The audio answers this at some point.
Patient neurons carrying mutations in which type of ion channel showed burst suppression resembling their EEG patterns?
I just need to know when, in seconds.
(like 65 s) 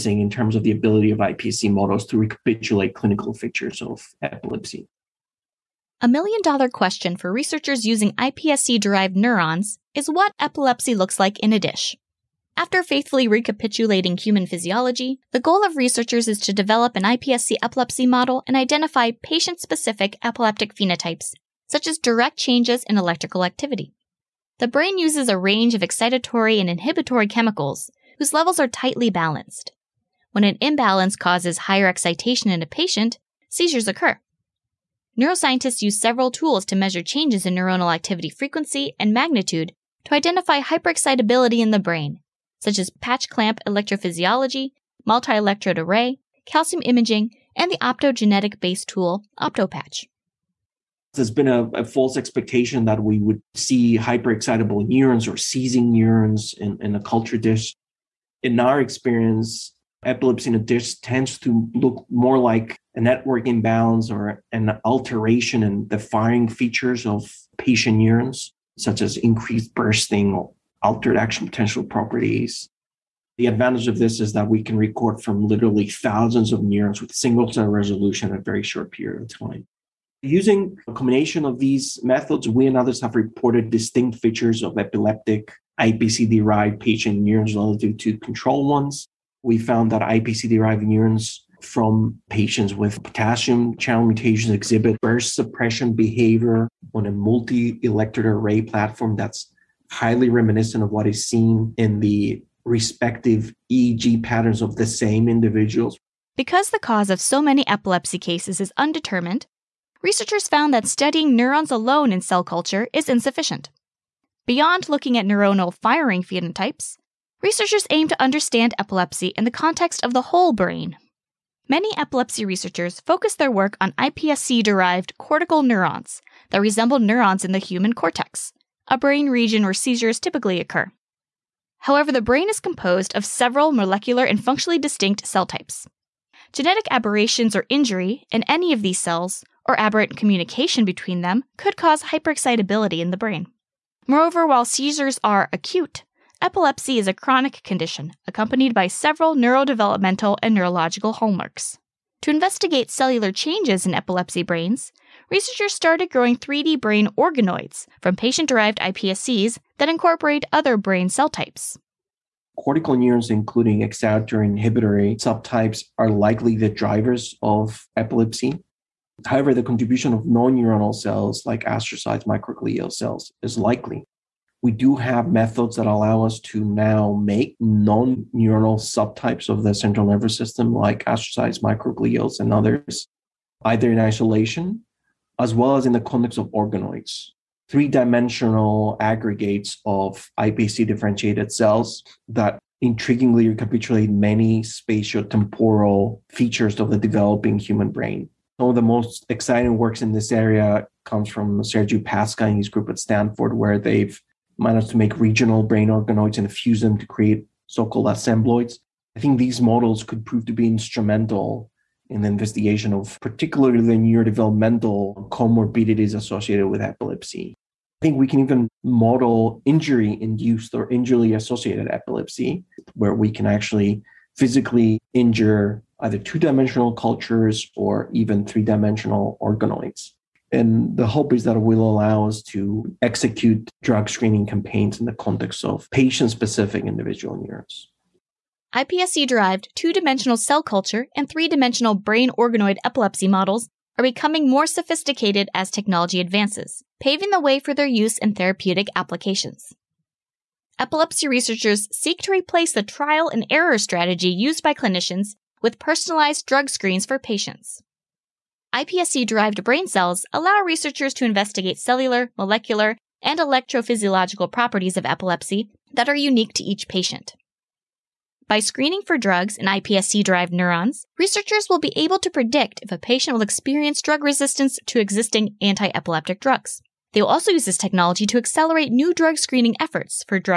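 93 s.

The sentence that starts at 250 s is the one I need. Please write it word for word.
Epilepsy researchers seek to replace the trial and error strategy used by clinicians with personalized drug screens for patients.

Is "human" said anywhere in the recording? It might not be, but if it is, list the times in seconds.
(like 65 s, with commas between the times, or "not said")
14 s, 127 s, 197 s.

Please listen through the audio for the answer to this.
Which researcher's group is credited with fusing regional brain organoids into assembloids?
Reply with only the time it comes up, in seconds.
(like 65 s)
201 s.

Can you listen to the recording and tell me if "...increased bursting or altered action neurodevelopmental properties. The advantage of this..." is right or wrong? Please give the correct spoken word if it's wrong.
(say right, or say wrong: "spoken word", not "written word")
wrong: "potential", not "neurodevelopmental".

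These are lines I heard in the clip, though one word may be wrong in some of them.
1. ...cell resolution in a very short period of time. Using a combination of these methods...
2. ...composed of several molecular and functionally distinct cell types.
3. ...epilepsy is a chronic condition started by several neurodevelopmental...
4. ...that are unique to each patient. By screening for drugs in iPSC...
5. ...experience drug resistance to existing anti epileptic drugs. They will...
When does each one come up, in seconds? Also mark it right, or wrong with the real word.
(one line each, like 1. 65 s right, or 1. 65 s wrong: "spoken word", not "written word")
1. 77 s right
2. 132 s right
3. 146 s wrong: "accompanied", not "started"
4. 265 s right
5. 273 s right.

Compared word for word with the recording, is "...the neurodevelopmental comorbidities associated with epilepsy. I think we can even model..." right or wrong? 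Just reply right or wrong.
right.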